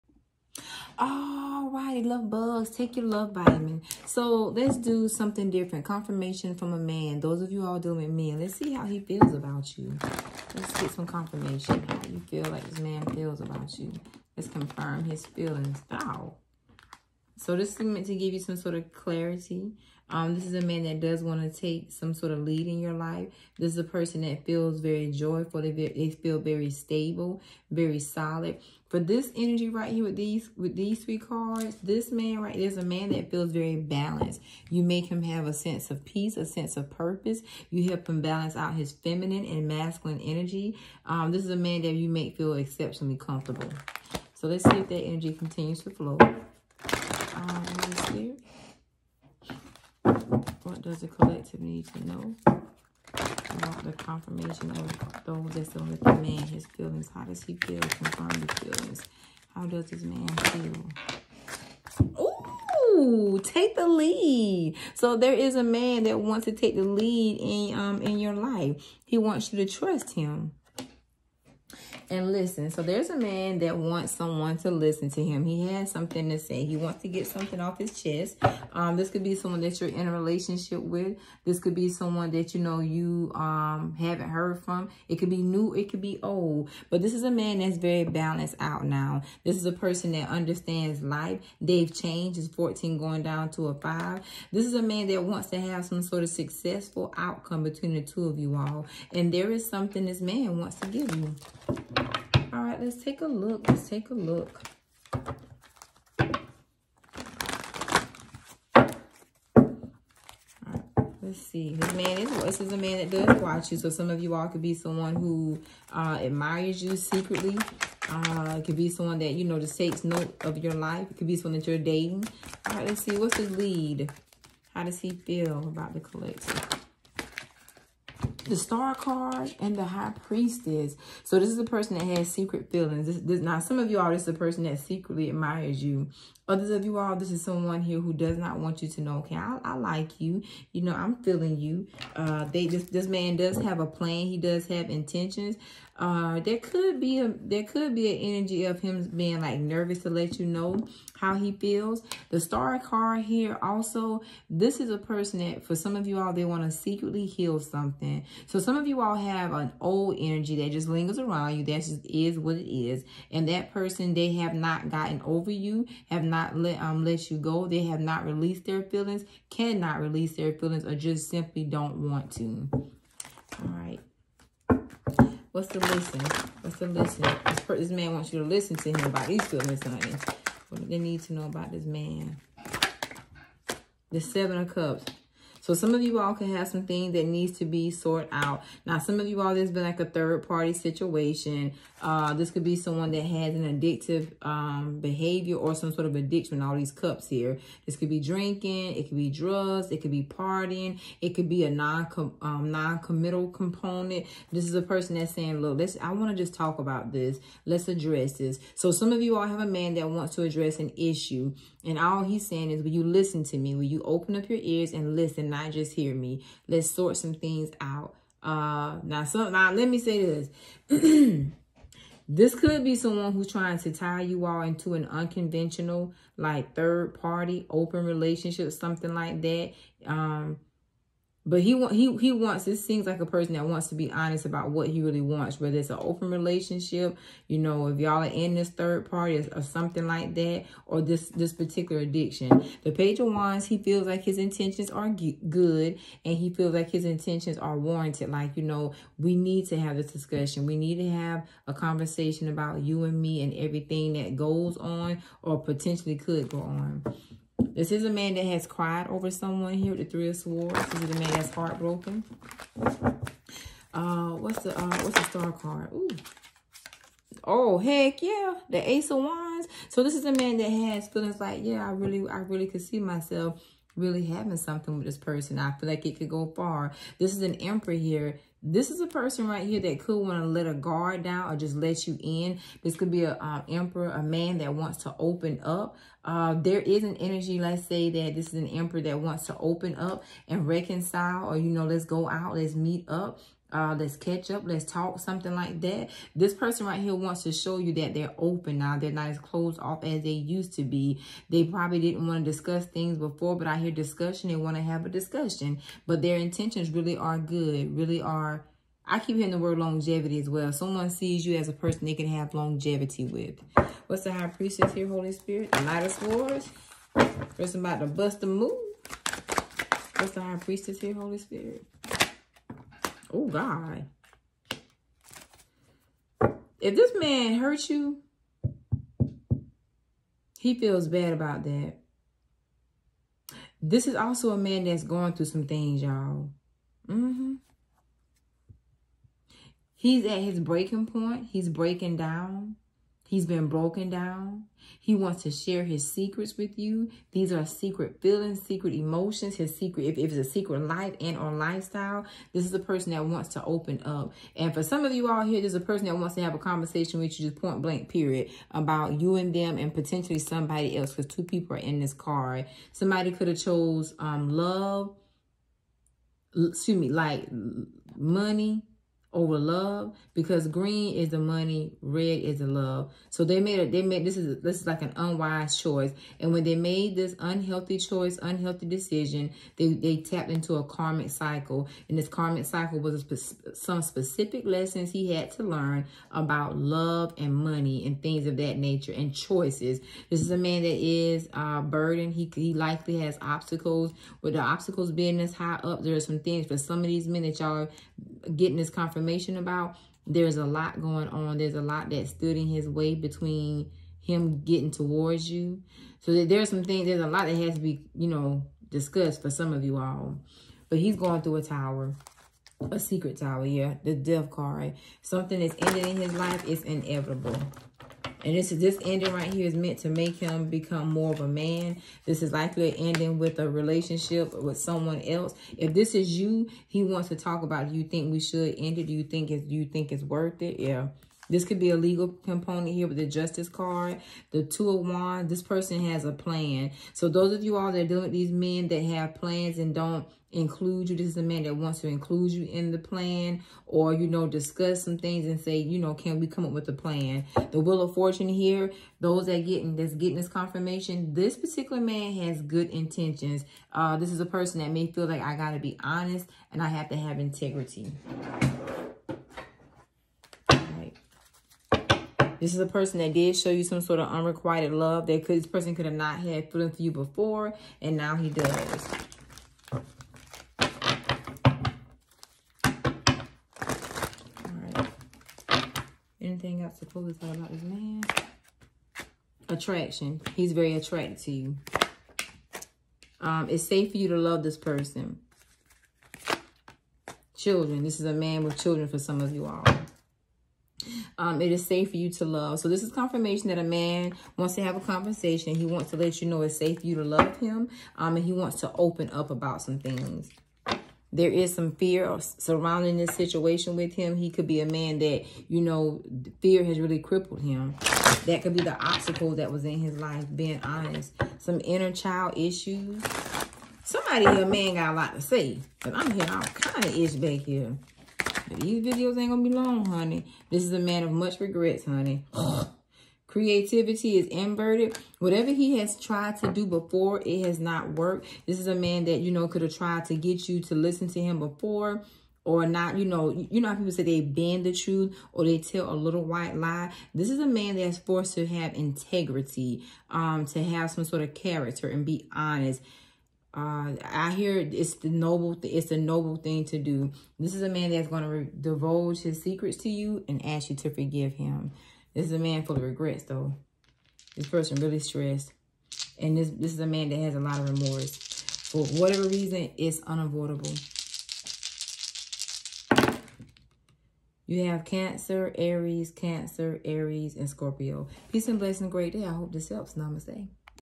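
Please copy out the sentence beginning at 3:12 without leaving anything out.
Uh, this could be someone that has an addictive um, behavior or some sort of addiction, all these cups here.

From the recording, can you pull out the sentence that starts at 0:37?
You help him balance out his feminine and masculine energy.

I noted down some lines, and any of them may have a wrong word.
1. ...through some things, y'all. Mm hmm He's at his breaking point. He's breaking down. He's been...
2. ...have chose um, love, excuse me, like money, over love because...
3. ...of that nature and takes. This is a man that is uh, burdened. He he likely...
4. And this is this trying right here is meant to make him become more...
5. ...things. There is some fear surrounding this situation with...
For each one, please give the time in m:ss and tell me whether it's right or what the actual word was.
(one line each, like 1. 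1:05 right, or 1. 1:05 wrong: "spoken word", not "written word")
1. 5:35 right
2. 6:03 right
3. 6:28 wrong: "choices", not "takes"
4. 6:58 wrong: "ending", not "trying"
5. 8:19 right.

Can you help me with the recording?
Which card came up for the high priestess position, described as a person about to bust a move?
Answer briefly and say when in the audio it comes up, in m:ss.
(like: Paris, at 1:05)
Knight of Swords, at 5:15.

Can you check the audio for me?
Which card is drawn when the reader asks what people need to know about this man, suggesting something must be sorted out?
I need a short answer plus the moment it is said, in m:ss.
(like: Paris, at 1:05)
Seven of Cups, at 3:04.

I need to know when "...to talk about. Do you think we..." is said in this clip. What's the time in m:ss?
7:07.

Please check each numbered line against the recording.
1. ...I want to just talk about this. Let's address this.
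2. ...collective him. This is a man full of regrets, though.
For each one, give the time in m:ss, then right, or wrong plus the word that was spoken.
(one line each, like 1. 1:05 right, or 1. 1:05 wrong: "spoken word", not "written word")
1. 3:26 right
2. 9:11 wrong: "forgive", not "collective".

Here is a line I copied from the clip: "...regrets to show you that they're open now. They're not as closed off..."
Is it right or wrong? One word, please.
wrong.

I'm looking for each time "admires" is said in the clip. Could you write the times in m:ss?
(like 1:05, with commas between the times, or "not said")
1:56, 2:15.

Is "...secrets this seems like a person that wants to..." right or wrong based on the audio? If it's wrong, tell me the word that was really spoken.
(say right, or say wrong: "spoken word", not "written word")
wrong: "wants", not "secrets".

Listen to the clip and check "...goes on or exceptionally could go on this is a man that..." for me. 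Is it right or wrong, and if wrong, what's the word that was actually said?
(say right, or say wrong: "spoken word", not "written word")
wrong: "potentially", not "exceptionally".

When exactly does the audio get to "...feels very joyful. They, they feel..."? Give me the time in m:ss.
0:24.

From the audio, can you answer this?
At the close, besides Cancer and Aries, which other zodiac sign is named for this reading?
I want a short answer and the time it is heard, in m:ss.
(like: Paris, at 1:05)
Scorpio, at 9:27.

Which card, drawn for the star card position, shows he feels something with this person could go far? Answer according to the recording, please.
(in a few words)
Ace of Wands.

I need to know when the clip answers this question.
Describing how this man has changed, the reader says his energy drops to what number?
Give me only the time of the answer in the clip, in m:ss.
1:32.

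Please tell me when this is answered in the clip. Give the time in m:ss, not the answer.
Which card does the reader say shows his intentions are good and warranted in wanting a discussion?
4:02.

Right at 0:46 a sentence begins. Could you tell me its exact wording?
Um, what does the collective need to know?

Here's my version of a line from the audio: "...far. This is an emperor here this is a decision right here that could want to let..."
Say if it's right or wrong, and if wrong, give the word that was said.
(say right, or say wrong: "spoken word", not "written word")
wrong: "person", not "decision".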